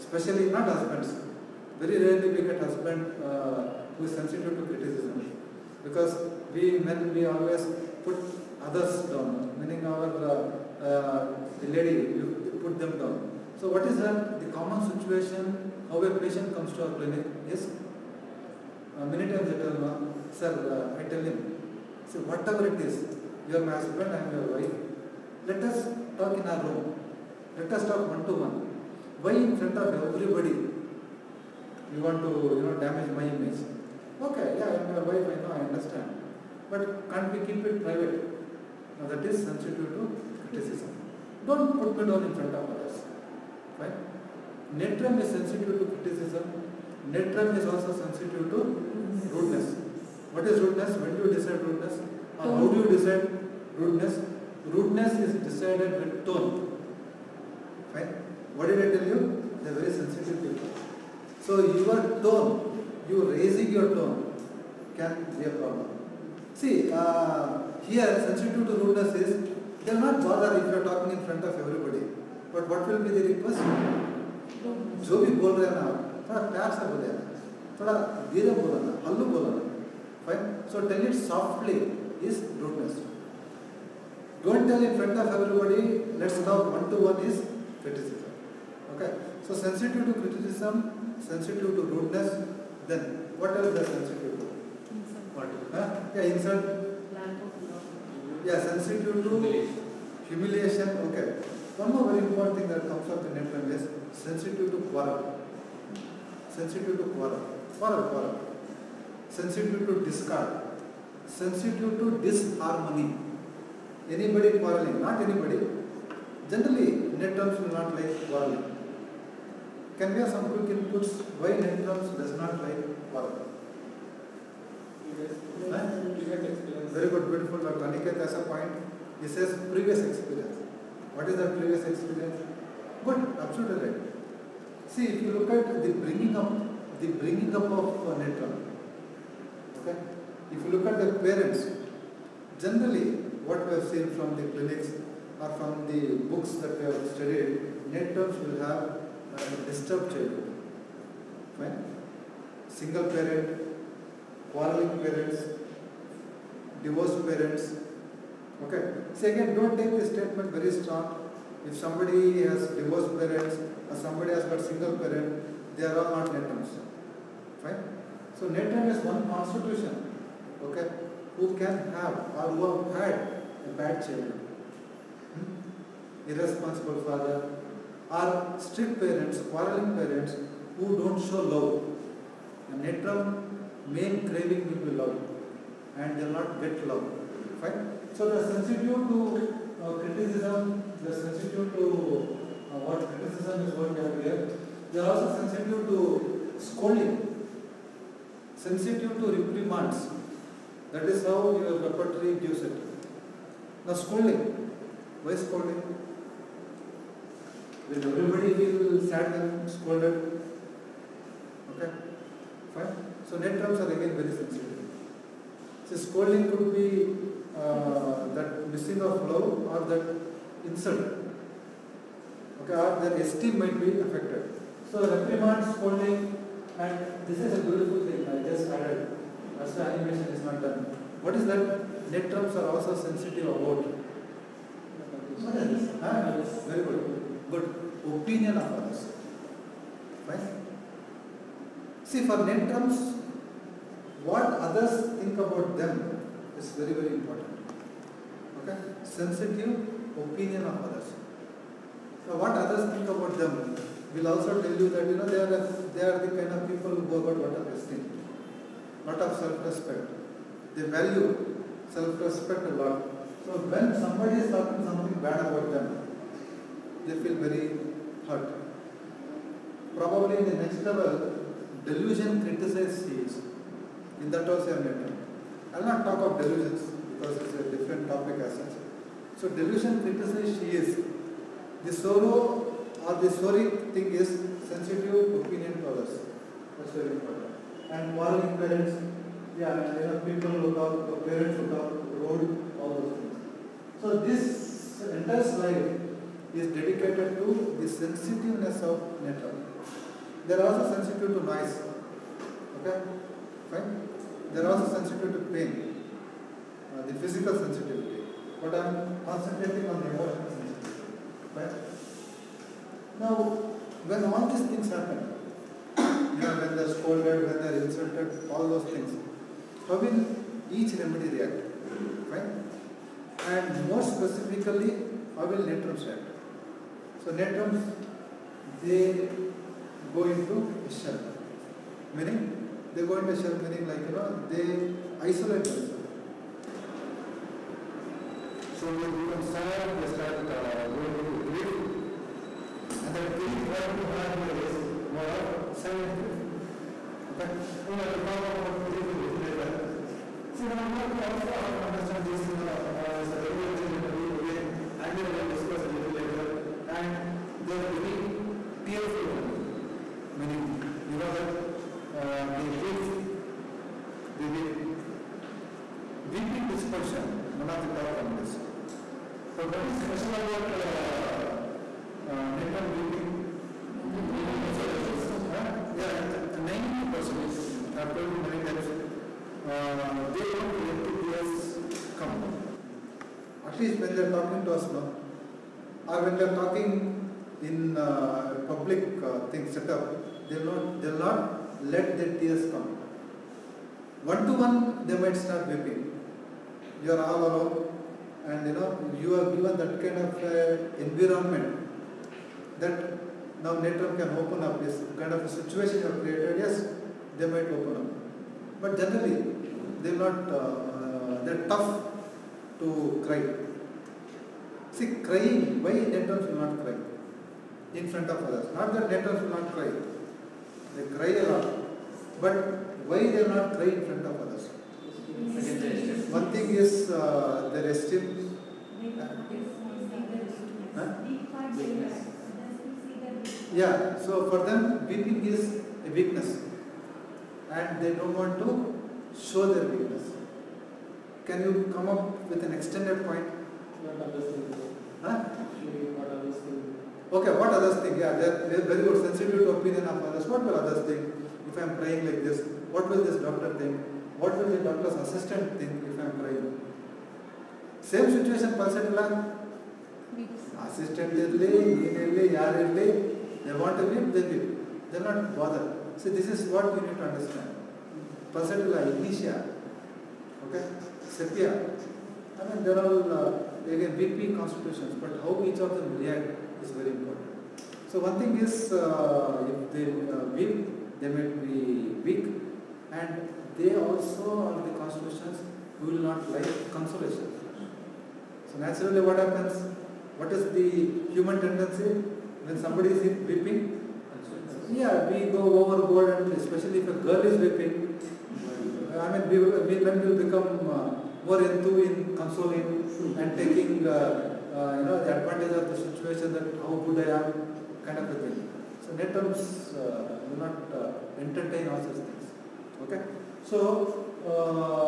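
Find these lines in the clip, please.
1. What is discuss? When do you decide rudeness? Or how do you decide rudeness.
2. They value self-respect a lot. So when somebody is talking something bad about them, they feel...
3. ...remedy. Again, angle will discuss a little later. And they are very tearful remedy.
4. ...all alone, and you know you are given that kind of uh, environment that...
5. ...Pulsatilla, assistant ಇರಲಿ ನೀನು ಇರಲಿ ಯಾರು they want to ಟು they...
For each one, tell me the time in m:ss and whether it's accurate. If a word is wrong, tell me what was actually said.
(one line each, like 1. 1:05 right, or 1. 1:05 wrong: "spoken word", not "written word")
1. 0:50 wrong: "rudeness", not "discuss"
2. 4:20 right
3. 5:53 right
4. 6:37 right
5. 7:38 right.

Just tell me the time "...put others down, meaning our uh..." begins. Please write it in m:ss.
0:08.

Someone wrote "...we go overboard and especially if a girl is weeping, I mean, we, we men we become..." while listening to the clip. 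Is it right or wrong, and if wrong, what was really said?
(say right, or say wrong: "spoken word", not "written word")
right.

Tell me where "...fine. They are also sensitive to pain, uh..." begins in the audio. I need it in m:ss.
5:03.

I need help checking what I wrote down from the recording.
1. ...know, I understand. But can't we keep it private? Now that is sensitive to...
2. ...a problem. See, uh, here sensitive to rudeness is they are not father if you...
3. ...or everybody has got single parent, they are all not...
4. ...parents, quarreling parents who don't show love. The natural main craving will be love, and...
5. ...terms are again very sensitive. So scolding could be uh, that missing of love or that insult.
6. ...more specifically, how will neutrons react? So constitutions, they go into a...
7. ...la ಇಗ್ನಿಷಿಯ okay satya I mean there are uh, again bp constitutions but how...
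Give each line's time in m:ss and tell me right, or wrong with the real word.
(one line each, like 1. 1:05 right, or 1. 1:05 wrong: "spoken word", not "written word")
1. 0:35 right
2. 1:05 wrong: "bother", not "father"
3. 2:43 wrong: "somebody", not "everybody"
4. 2:58 right
5. 3:33 right
6. 5:23 wrong: "neutrons", not "constitutions"
7. 7:48 right.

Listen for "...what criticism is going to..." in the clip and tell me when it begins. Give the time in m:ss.
3:12.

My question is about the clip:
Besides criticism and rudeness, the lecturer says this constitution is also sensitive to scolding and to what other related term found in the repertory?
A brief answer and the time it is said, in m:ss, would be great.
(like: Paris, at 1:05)
Reprimands, at 3:18.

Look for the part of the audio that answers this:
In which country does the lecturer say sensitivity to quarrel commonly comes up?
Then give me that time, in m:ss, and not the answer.
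1:43.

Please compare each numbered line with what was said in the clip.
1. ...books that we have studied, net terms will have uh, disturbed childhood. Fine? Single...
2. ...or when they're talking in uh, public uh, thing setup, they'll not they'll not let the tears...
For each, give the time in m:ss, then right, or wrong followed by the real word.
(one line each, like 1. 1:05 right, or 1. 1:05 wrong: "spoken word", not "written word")
1. 2:26 right
2. 6:26 right.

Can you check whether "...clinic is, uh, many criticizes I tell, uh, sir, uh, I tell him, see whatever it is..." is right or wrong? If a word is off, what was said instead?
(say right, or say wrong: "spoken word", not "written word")
wrong: "times", not "criticizes".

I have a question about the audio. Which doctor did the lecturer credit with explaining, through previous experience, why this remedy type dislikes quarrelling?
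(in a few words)
Dr. Aniket.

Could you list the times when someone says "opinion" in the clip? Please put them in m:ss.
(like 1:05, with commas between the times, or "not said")
3:58, 4:10, 4:45, 7:29.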